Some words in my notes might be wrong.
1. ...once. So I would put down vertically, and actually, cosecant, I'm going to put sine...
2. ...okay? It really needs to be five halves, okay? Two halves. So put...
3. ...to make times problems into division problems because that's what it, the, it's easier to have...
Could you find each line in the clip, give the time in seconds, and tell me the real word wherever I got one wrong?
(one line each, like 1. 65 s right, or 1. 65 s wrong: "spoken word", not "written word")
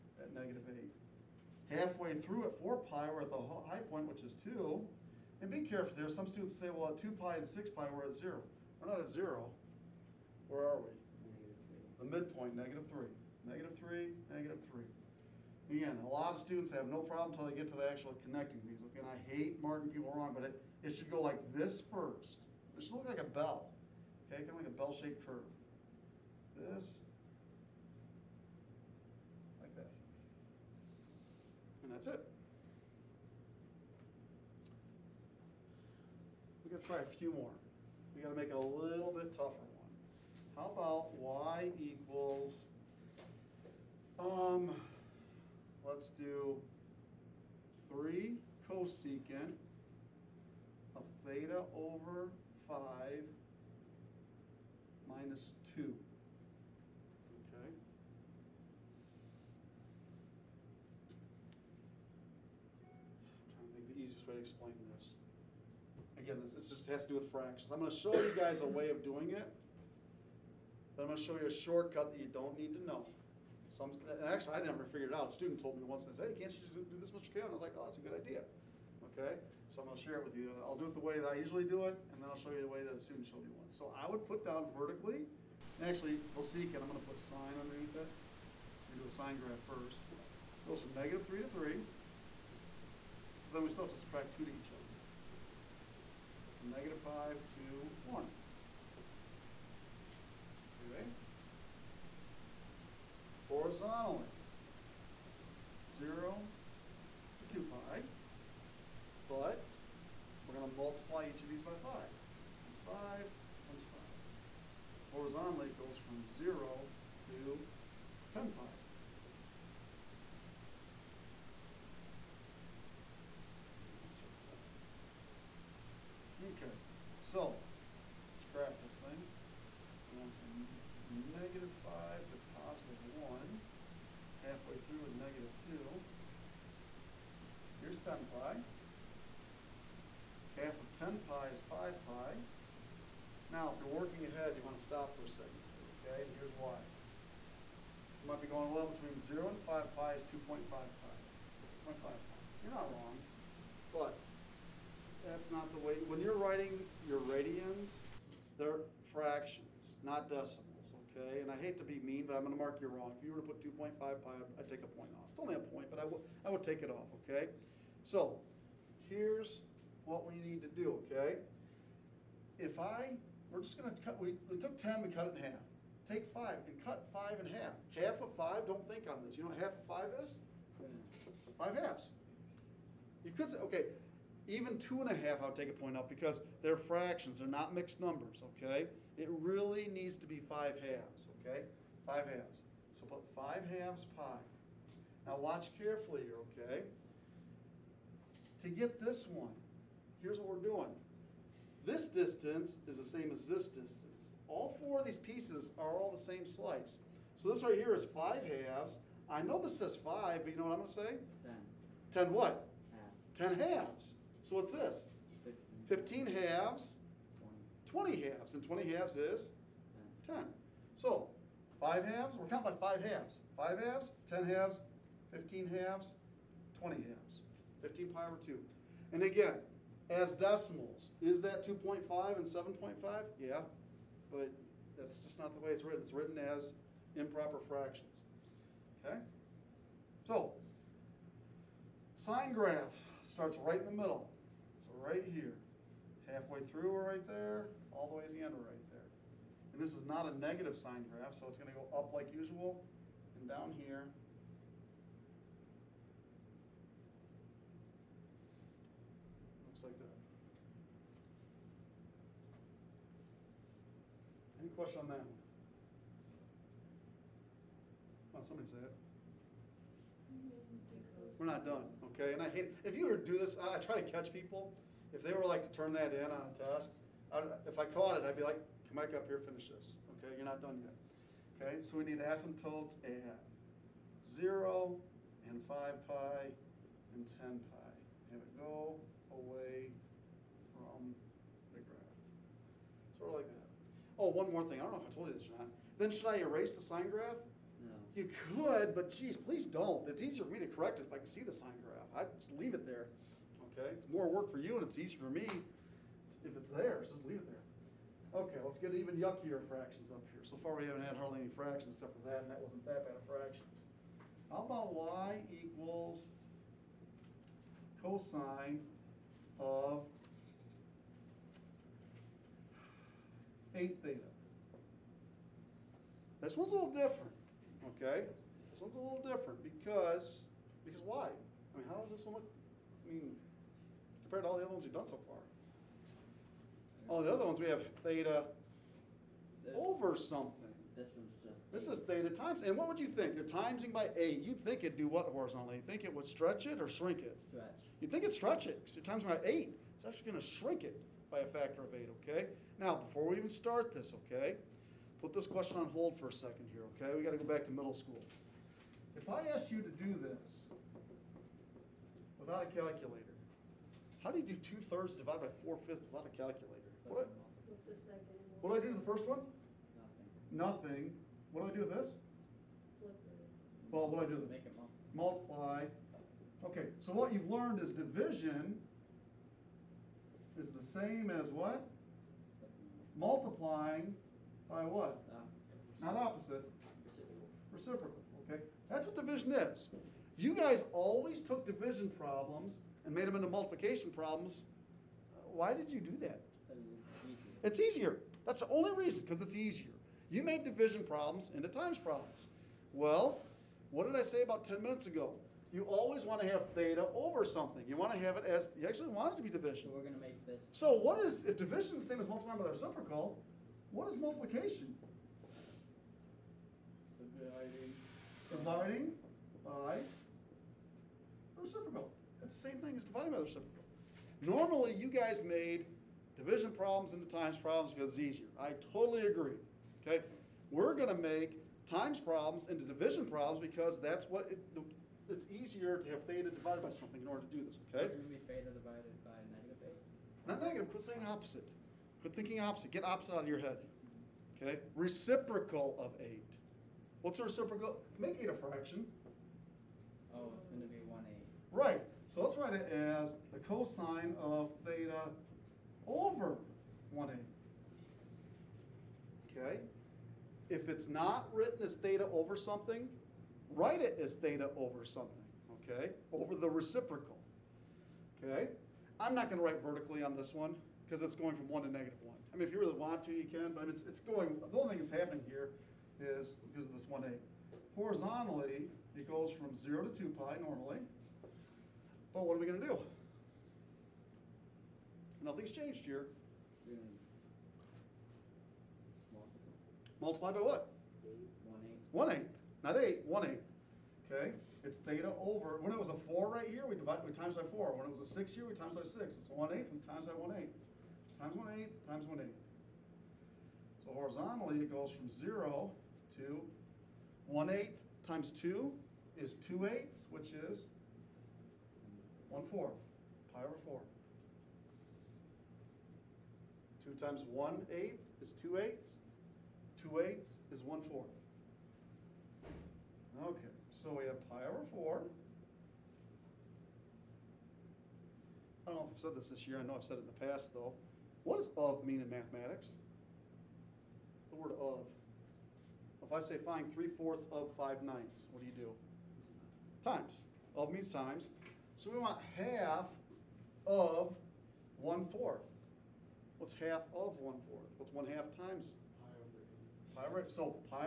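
1. 83 s right
2. 188 s wrong: "Five", not "Two"
3. 431 s right.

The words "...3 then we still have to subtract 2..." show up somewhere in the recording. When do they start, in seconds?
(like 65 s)
91 s.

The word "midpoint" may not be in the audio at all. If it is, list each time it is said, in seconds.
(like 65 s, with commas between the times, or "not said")
12 s.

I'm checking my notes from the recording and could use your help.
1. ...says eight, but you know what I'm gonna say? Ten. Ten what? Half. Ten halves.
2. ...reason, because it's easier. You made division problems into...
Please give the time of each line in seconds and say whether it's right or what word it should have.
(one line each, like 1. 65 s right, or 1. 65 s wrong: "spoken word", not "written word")
1. 209 s wrong: "five", not "eight"
2. 398 s right.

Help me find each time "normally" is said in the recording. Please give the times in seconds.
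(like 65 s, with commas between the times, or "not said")
424 s, 480 s.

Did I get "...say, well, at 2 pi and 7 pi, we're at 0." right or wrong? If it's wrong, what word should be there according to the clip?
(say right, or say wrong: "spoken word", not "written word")
wrong: "6", not "7".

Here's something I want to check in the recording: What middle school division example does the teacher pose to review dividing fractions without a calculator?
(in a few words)
two thirds divided by four fifths.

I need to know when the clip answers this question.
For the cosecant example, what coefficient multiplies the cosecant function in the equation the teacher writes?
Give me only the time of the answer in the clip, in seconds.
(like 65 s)
47 s.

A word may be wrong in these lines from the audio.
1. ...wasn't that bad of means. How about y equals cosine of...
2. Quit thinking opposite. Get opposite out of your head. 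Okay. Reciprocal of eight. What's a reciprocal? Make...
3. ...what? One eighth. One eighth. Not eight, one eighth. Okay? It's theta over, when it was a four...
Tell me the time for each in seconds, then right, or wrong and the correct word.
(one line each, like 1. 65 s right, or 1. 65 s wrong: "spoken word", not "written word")
1. 312 s wrong: "fractions", not "means"
2. 442 s right
3. 490 s right.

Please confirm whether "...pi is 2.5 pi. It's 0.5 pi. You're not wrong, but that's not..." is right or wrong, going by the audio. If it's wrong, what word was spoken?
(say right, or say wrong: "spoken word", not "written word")
right.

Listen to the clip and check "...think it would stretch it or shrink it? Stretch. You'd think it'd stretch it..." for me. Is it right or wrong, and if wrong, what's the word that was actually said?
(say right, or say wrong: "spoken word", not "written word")
right.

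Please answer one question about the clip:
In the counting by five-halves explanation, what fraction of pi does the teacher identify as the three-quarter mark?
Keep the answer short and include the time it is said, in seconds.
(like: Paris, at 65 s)
15 pi over 2, at 227 s.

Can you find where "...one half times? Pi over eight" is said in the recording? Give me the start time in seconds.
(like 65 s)
548 s.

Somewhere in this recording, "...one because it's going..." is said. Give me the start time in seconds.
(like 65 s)
470 s.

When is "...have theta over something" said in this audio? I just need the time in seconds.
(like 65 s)
406 s.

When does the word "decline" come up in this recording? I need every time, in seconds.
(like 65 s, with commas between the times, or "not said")
not said.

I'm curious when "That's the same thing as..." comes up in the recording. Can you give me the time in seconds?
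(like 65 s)
422 s.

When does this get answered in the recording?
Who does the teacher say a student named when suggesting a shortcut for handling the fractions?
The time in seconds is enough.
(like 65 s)
77 s.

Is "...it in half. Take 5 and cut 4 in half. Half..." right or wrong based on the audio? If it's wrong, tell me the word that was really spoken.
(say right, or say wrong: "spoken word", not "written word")
wrong: "5", not "4".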